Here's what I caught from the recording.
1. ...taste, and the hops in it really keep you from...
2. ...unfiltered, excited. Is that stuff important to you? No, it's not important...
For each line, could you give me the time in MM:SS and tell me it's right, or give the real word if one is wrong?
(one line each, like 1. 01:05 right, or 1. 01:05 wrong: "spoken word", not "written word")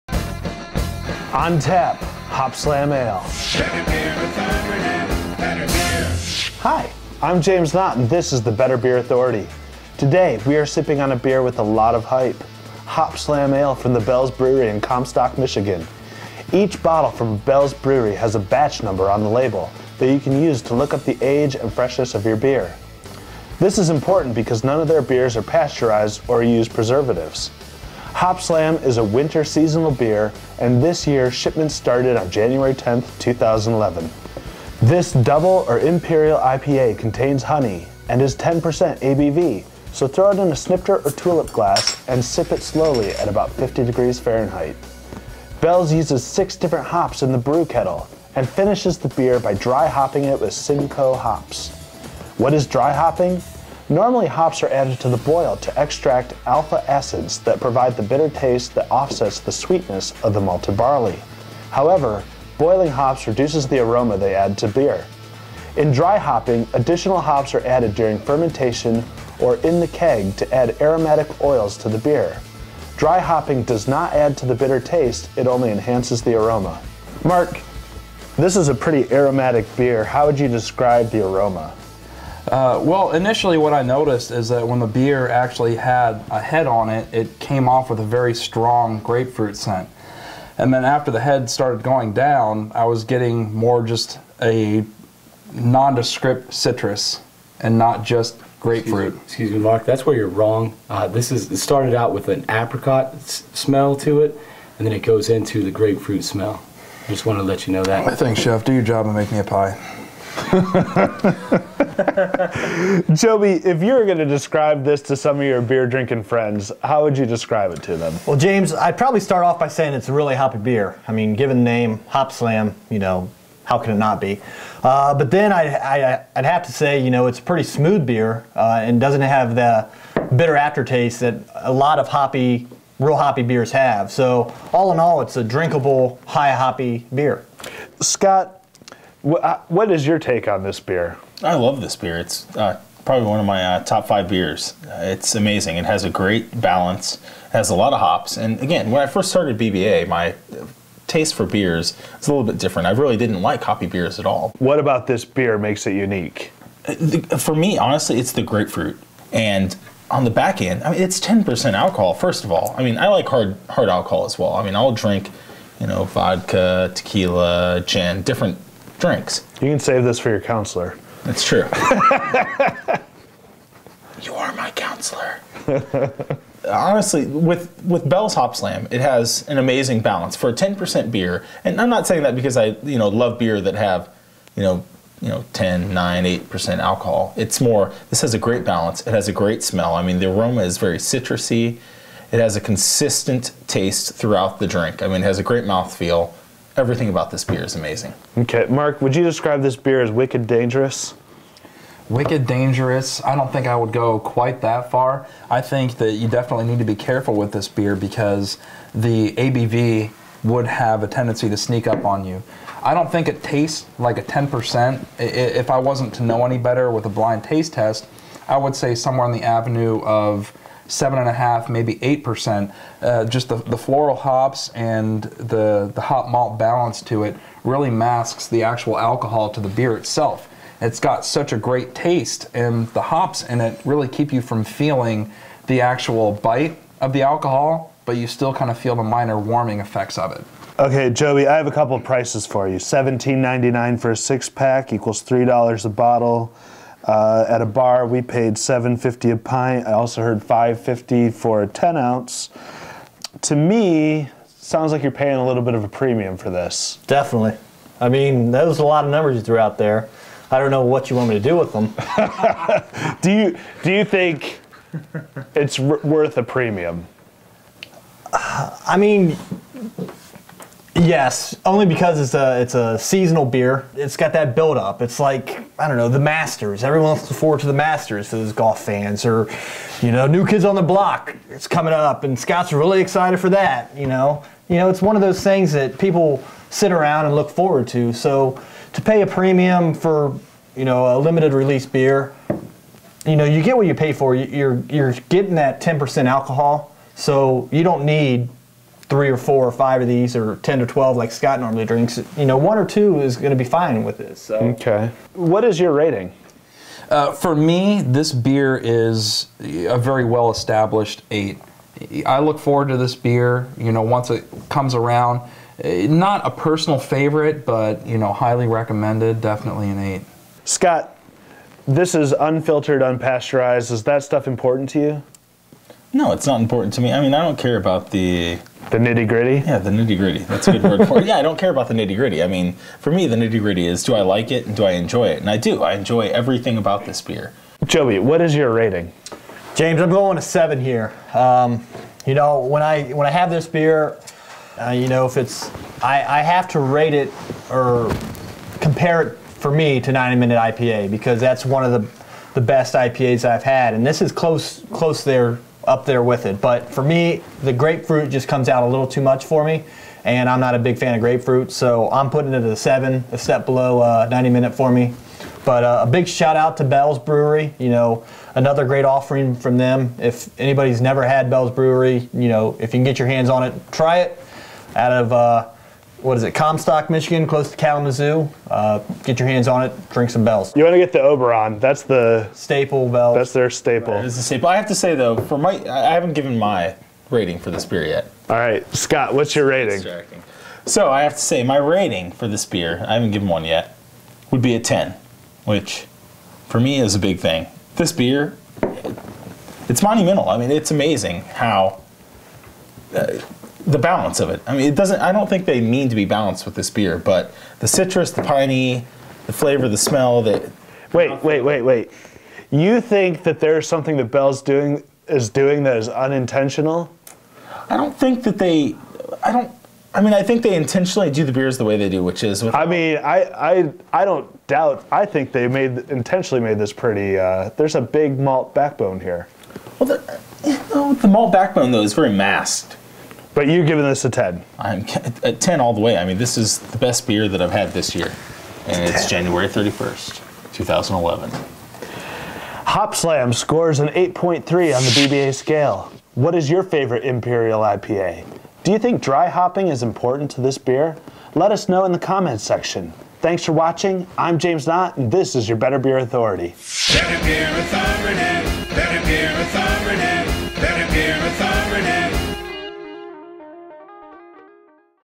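1. 03:51 right
2. 05:22 wrong: "unpasteurized", not "excited".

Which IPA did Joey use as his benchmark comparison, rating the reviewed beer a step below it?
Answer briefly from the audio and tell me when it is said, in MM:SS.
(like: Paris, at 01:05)
90 Minute IPA, at 05:50.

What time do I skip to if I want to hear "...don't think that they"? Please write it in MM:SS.
06:57.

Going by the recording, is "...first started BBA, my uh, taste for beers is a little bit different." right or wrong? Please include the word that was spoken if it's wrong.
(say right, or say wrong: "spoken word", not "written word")
right.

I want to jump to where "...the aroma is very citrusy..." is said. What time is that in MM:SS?
03:10.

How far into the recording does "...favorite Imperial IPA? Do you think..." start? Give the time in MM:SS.
07:26.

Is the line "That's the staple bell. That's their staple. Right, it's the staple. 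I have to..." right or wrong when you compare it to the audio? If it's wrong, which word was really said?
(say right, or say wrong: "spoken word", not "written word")
right.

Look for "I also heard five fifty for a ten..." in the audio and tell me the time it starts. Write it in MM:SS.
04:09.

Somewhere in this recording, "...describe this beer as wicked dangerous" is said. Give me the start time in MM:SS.
03:19.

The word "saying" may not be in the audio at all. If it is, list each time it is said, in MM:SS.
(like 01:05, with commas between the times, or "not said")
01:59, 03:02.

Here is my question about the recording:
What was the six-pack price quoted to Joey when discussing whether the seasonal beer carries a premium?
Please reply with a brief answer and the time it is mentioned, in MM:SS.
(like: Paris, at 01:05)
$17.99, at 04:02.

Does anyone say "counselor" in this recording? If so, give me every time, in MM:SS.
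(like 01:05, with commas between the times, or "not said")
02:50, 02:54.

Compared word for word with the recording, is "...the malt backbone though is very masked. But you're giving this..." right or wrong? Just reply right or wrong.
right.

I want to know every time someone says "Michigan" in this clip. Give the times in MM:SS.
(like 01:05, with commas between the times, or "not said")
00:15, 06:17.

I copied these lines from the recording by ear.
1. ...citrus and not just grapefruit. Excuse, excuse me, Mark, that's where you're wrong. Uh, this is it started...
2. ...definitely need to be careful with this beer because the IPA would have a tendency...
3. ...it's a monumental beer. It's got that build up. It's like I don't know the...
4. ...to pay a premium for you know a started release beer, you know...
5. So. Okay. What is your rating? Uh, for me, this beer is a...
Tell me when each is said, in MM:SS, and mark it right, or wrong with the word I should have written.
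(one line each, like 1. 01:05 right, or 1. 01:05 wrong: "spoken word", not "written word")
1. 01:36 right
2. 03:26 wrong: "ABV", not "IPA"
3. 04:32 wrong: "seasonal", not "monumental"
4. 04:48 wrong: "limited", not "started"
5. 05:04 right.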